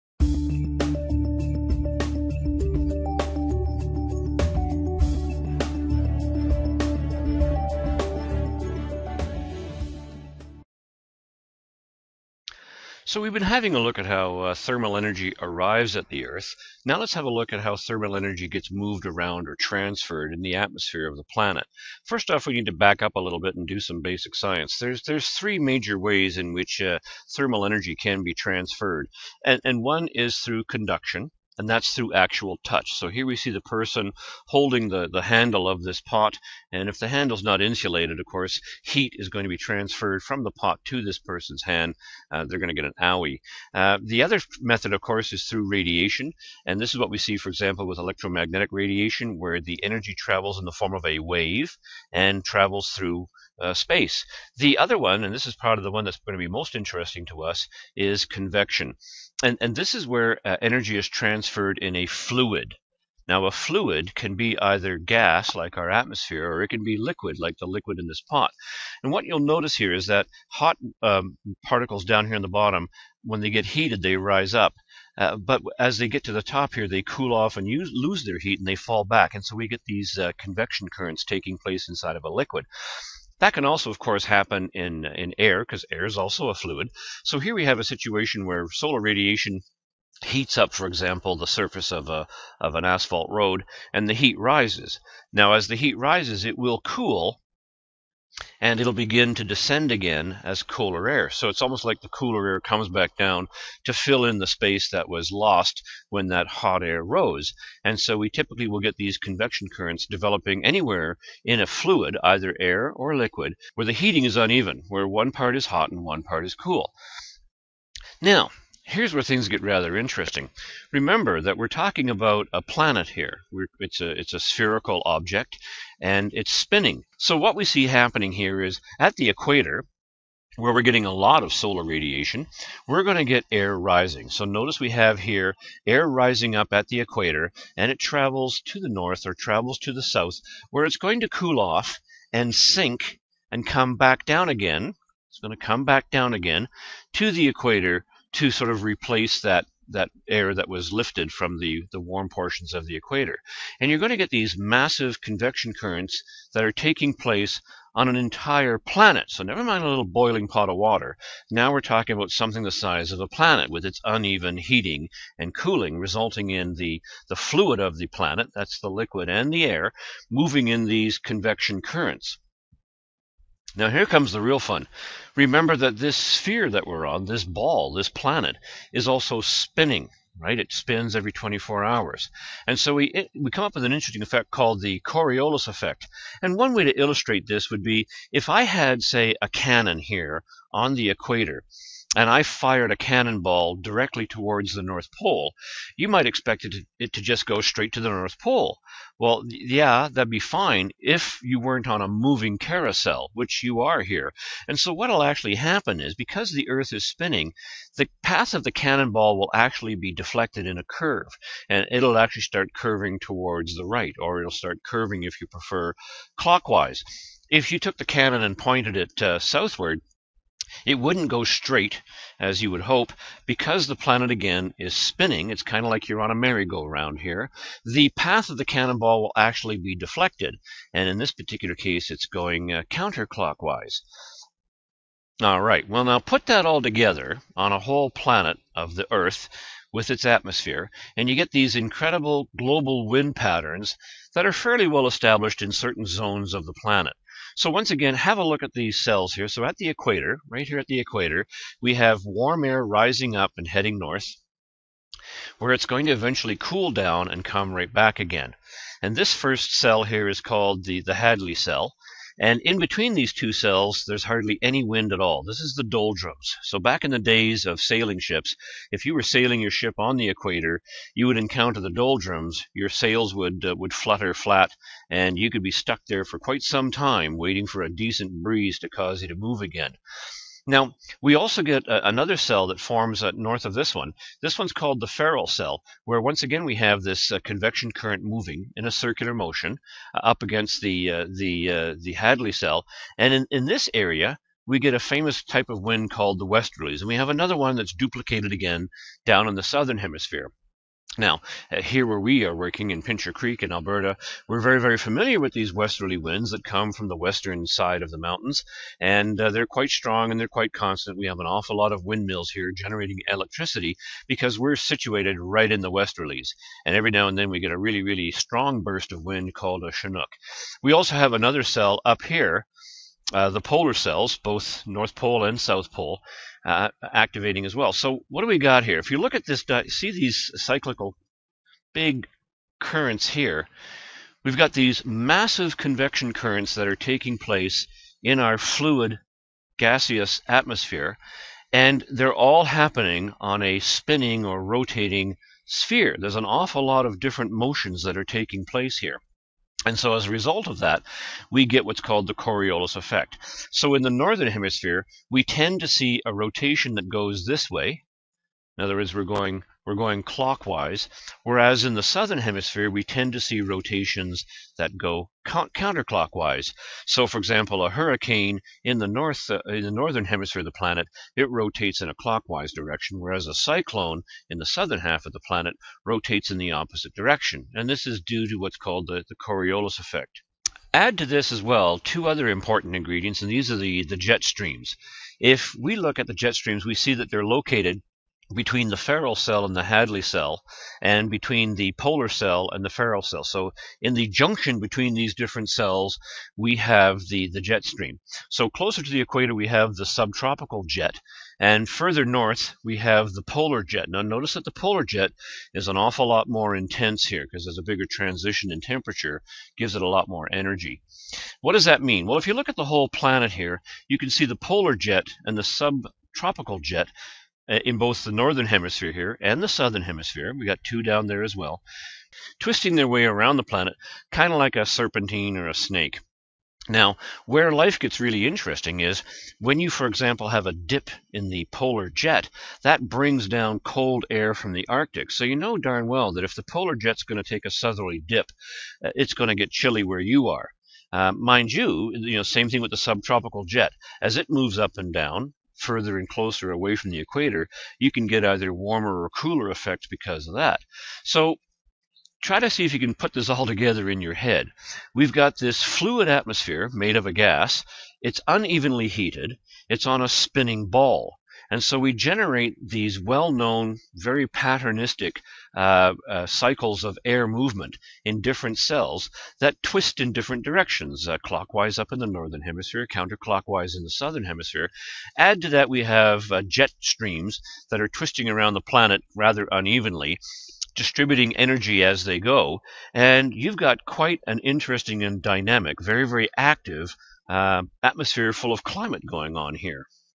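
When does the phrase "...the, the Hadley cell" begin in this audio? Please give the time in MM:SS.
04:20.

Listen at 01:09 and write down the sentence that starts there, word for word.
And what you'll notice here is that hot um, particles down here in the bottom, when they get heated, they rise up.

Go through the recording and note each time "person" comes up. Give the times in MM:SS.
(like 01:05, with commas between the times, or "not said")
00:33, 00:41.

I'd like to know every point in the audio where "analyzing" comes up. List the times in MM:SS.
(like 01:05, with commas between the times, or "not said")
not said.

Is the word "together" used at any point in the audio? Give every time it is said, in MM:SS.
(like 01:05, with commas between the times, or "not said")
03:56, 07:33.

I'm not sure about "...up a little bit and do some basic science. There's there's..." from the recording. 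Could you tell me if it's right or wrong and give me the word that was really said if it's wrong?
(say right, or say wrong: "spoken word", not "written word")
right.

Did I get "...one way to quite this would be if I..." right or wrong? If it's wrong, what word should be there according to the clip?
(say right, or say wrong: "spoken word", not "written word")
wrong: "illustrate", not "quite".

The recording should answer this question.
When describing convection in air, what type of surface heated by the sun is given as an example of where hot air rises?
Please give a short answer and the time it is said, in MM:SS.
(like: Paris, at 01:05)
asphalt road, at 01:32.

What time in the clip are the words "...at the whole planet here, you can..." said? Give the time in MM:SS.
06:52.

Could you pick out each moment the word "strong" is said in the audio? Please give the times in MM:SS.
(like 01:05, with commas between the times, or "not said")
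05:09, 05:18.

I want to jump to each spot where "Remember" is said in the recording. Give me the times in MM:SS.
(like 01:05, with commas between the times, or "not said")
02:00, 02:55.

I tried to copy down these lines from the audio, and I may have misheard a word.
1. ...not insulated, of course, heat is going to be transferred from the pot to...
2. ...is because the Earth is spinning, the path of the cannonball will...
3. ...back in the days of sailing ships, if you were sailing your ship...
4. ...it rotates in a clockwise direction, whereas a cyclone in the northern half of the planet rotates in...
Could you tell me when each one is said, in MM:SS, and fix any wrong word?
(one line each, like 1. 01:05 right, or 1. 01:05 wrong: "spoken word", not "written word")
1. 00:37 right
2. 03:26 right
3. 04:26 right
4. 06:11 wrong: "southern", not "northern".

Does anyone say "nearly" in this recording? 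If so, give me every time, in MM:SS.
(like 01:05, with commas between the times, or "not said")
not said.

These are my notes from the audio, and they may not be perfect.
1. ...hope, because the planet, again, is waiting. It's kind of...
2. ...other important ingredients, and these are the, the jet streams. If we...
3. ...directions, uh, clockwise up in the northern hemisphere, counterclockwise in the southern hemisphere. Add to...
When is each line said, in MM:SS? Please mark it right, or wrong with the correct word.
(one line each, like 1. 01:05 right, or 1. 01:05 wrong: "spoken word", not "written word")
1. 03:42 wrong: "spinning", not "waiting"
2. 06:22 right
3. 07:50 right.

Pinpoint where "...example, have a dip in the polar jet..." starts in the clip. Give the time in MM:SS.
07:10.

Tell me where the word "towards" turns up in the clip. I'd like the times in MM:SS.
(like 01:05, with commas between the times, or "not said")
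03:14, 03:33.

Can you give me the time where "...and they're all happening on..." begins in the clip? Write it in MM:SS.
05:41.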